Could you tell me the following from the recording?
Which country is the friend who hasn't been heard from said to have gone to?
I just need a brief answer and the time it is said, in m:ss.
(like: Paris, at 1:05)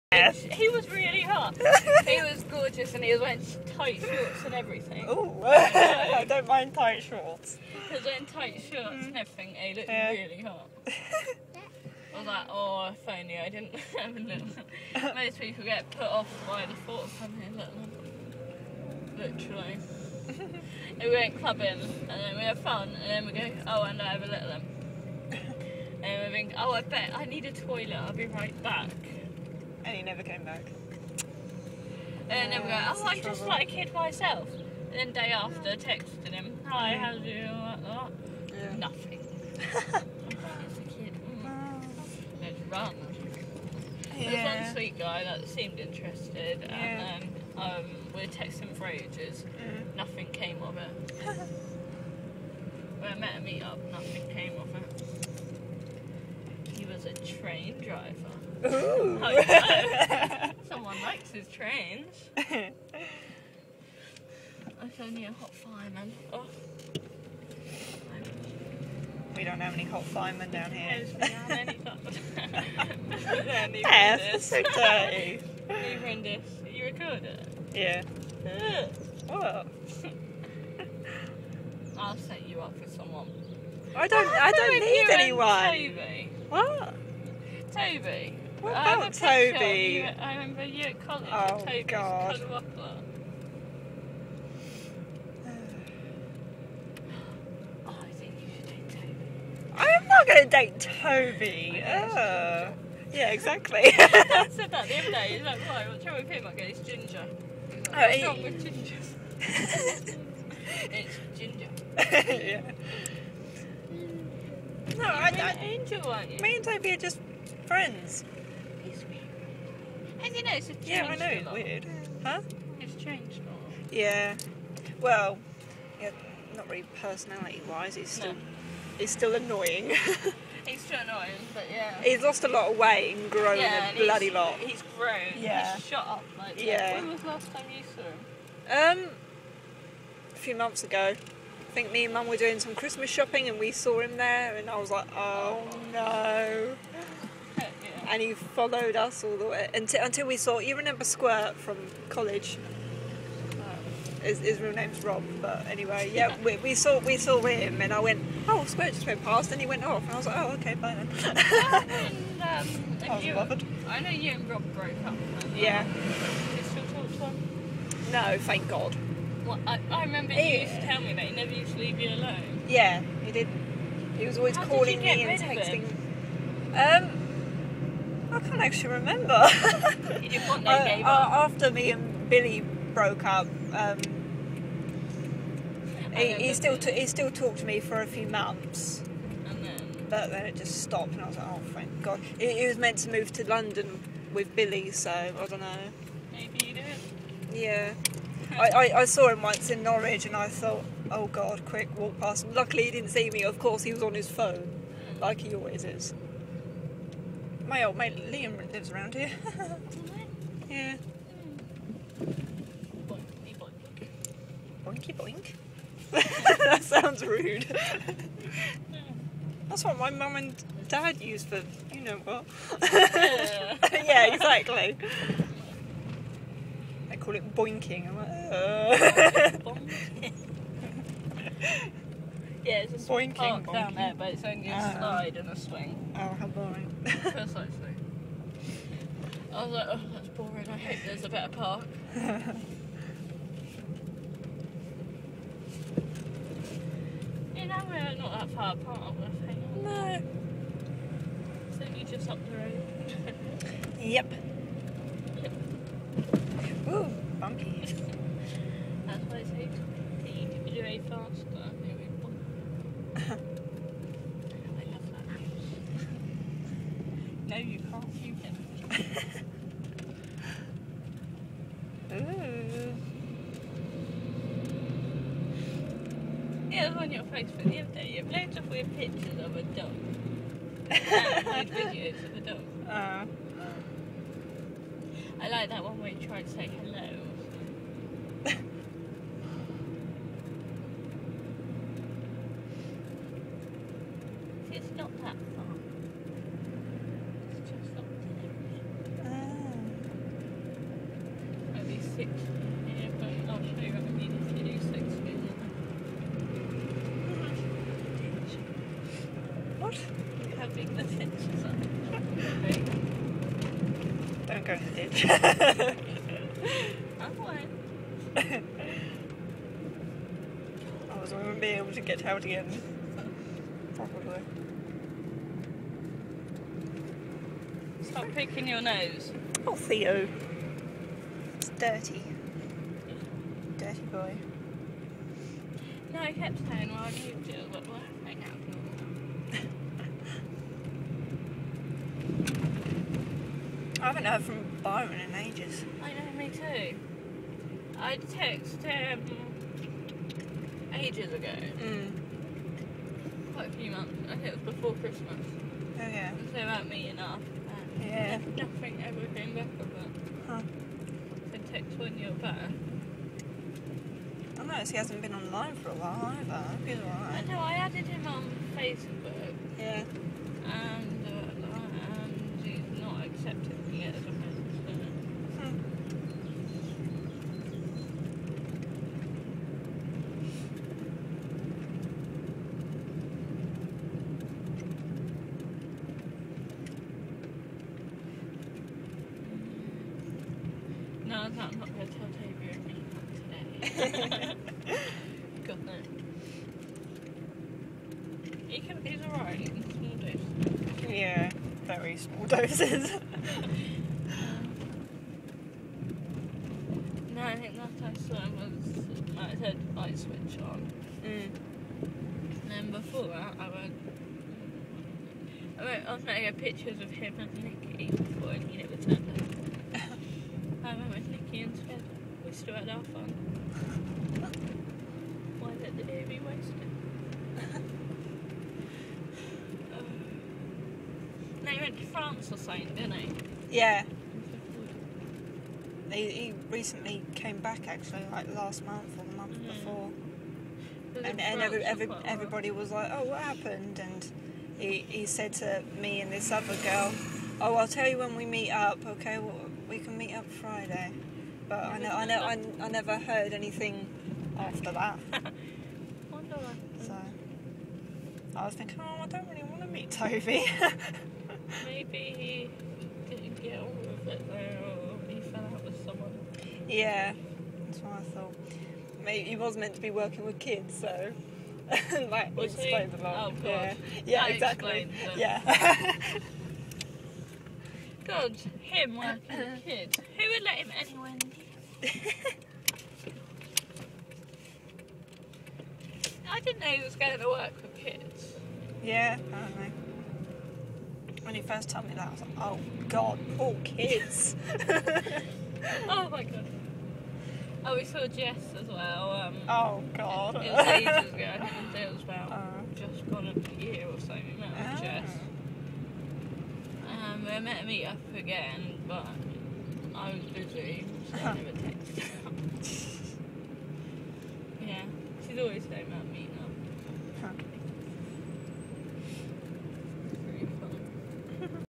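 France, at 7:12.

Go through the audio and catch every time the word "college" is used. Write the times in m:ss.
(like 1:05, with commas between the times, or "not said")
1:31, 2:32.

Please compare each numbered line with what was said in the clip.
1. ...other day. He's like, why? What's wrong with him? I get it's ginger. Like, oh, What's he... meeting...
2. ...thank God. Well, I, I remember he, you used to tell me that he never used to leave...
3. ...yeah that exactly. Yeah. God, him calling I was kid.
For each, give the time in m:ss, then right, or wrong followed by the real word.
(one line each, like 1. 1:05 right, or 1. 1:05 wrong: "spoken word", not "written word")
1. 1:44 wrong: "wrong", not "meeting"
2. 2:48 right
3. 7:54 wrong: "working", not "calling".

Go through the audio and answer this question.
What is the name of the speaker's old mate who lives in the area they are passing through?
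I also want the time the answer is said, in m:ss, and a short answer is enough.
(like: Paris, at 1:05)
Liam, at 3:28.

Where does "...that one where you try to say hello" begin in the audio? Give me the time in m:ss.
4:45.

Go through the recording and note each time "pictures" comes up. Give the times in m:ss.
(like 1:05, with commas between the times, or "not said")
4:38, 6:56.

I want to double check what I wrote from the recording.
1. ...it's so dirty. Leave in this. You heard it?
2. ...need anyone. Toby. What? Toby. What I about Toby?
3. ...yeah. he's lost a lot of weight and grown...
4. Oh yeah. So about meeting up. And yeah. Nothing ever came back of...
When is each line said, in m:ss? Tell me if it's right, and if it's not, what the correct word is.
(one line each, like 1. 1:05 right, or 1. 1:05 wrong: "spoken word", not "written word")
1. 1:14 wrong: "record", not "heard"
2. 1:24 right
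3. 2:11 right
4. 5:55 right.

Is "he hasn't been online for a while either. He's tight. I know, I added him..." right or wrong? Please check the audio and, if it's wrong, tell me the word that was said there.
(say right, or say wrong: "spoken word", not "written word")
wrong: "alright", not "tight".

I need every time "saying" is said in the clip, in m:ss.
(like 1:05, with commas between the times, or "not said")
5:36, 8:35.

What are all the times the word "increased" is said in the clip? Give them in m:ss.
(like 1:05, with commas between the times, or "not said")
not said.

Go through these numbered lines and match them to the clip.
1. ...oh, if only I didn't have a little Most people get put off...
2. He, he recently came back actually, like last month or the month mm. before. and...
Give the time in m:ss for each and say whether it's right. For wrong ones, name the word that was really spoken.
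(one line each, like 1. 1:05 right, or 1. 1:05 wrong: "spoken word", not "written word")
1. 0:12 right
2. 7:16 right.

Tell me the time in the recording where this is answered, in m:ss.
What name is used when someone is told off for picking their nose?
5:29.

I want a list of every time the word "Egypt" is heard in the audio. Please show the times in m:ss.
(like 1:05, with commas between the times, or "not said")
not said.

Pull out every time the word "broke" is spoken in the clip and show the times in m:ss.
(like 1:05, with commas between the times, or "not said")
2:44, 3:02.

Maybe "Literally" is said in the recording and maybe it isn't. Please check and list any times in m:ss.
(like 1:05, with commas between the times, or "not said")
0:19.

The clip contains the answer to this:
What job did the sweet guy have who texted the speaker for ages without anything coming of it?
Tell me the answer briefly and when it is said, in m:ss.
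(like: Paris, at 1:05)
Train driver, at 0:57.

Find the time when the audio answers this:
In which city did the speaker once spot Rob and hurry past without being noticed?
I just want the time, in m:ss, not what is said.
3:19.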